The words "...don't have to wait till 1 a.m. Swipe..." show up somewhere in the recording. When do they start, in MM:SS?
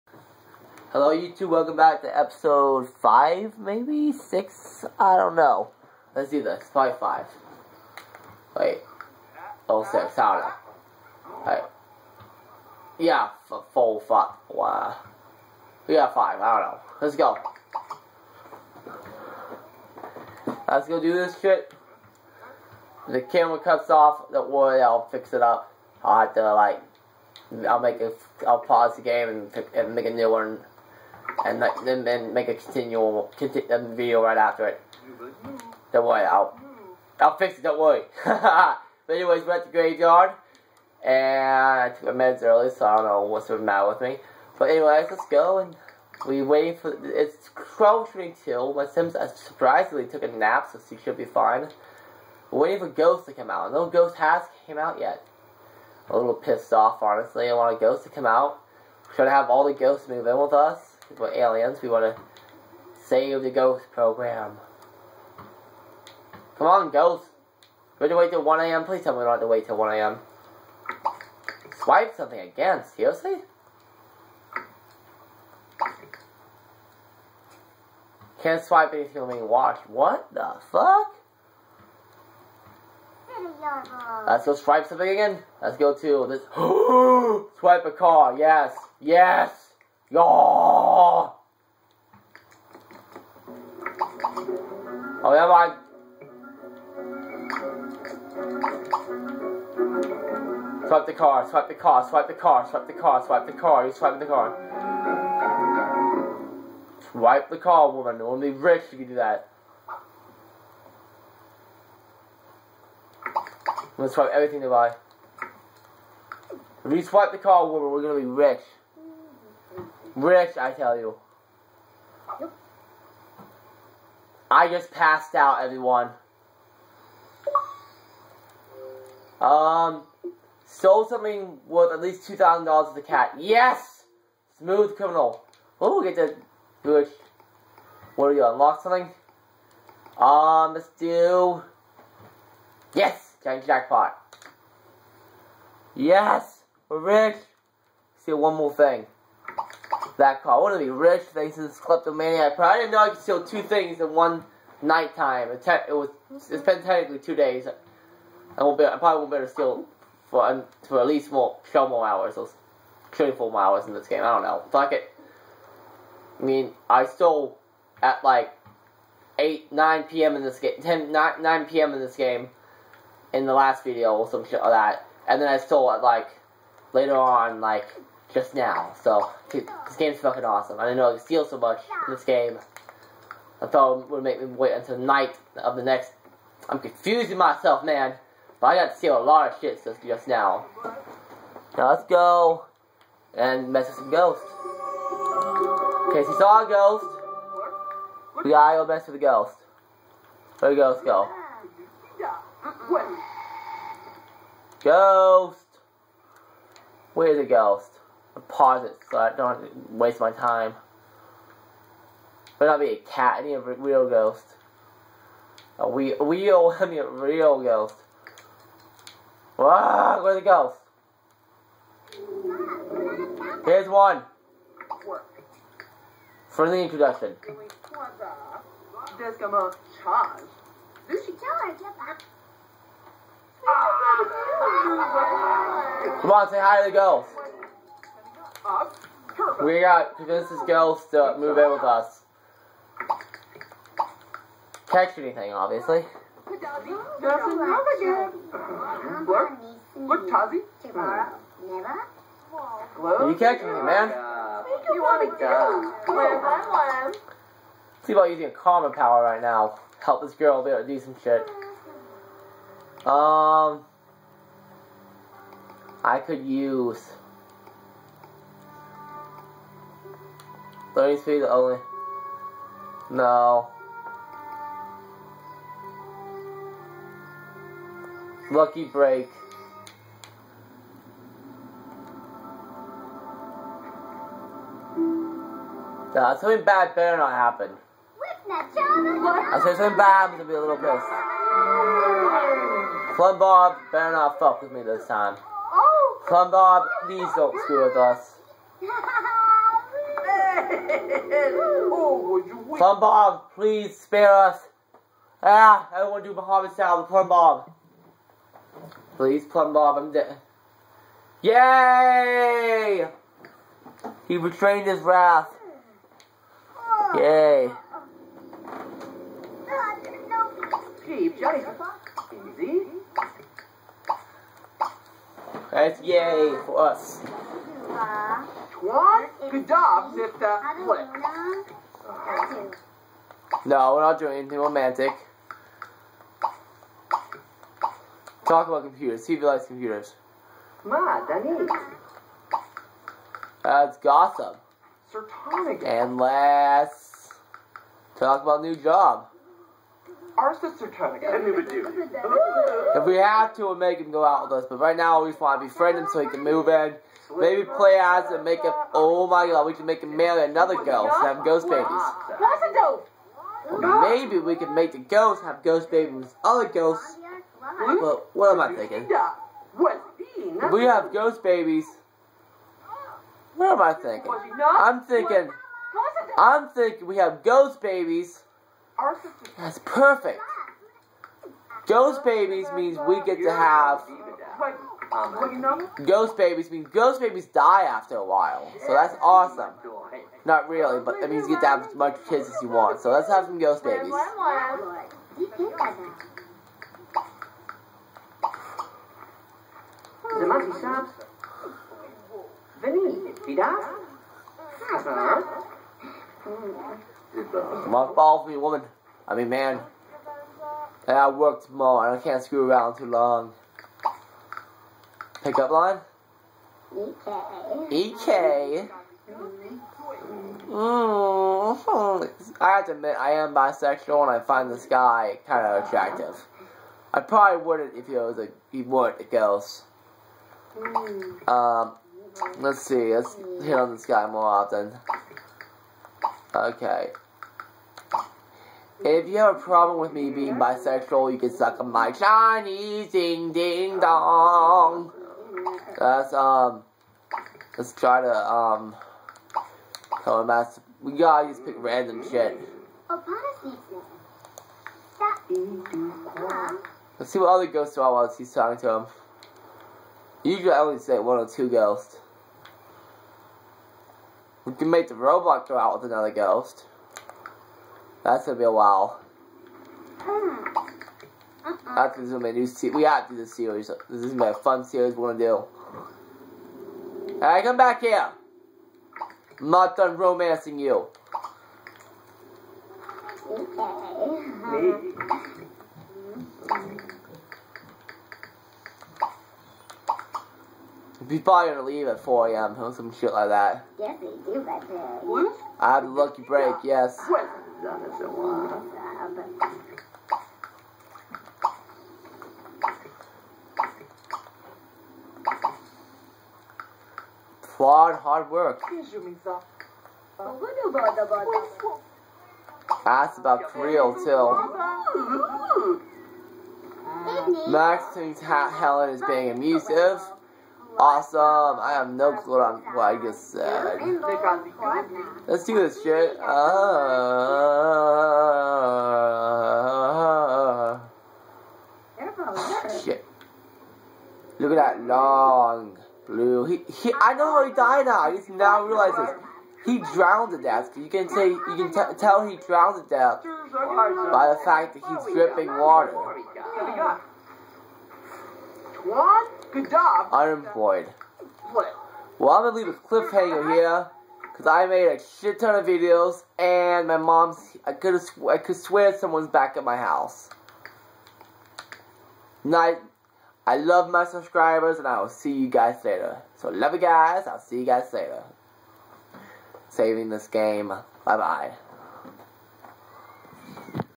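01:09.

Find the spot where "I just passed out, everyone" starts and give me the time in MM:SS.
02:04.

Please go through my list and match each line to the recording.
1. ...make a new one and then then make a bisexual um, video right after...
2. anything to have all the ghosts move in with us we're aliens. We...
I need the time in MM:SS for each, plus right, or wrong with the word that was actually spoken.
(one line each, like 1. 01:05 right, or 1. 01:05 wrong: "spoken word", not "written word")
1. 00:29 wrong: "continual", not "bisexual"
2. 00:59 wrong: "trying", not "anything".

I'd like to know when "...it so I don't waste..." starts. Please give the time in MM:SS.
03:28.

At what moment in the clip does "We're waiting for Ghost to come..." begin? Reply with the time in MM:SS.
00:52.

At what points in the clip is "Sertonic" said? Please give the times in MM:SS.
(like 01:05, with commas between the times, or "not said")
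05:45.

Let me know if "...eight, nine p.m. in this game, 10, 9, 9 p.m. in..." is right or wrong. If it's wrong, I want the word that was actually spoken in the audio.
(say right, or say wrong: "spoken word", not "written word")
right.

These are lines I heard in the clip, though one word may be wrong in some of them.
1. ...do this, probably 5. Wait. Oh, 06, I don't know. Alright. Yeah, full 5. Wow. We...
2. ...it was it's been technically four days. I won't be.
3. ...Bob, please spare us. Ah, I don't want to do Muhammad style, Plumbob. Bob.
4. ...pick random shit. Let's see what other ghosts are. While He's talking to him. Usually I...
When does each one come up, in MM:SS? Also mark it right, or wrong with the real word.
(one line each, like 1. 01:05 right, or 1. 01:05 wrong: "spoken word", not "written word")
1. 00:06 right
2. 02:35 wrong: "two", not "four"
3. 05:03 right
4. 07:31 right.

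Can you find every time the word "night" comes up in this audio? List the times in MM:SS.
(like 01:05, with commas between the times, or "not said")
02:34, 03:04, 09:22.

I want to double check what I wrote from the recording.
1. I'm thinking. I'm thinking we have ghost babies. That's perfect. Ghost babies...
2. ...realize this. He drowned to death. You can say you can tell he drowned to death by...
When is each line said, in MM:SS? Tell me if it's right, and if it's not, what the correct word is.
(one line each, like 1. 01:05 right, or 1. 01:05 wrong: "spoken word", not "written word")
1. 06:14 right
2. 08:58 right.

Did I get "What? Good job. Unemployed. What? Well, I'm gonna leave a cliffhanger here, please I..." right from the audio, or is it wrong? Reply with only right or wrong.
wrong.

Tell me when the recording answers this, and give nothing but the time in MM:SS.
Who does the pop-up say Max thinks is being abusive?
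08:38.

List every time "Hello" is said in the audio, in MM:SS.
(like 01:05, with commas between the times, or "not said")
00:00.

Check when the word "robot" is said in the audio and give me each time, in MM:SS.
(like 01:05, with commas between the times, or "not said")
07:45.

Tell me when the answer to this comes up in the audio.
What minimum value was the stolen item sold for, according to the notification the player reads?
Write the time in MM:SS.
02:12.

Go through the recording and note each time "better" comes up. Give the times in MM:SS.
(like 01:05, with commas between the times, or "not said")
04:46, 04:53.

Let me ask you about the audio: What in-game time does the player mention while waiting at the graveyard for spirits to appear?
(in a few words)
12:22.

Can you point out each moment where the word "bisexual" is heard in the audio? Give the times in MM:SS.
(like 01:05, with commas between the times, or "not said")
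07:03, 07:20.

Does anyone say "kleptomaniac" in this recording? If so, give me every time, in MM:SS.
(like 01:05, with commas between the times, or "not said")
02:31.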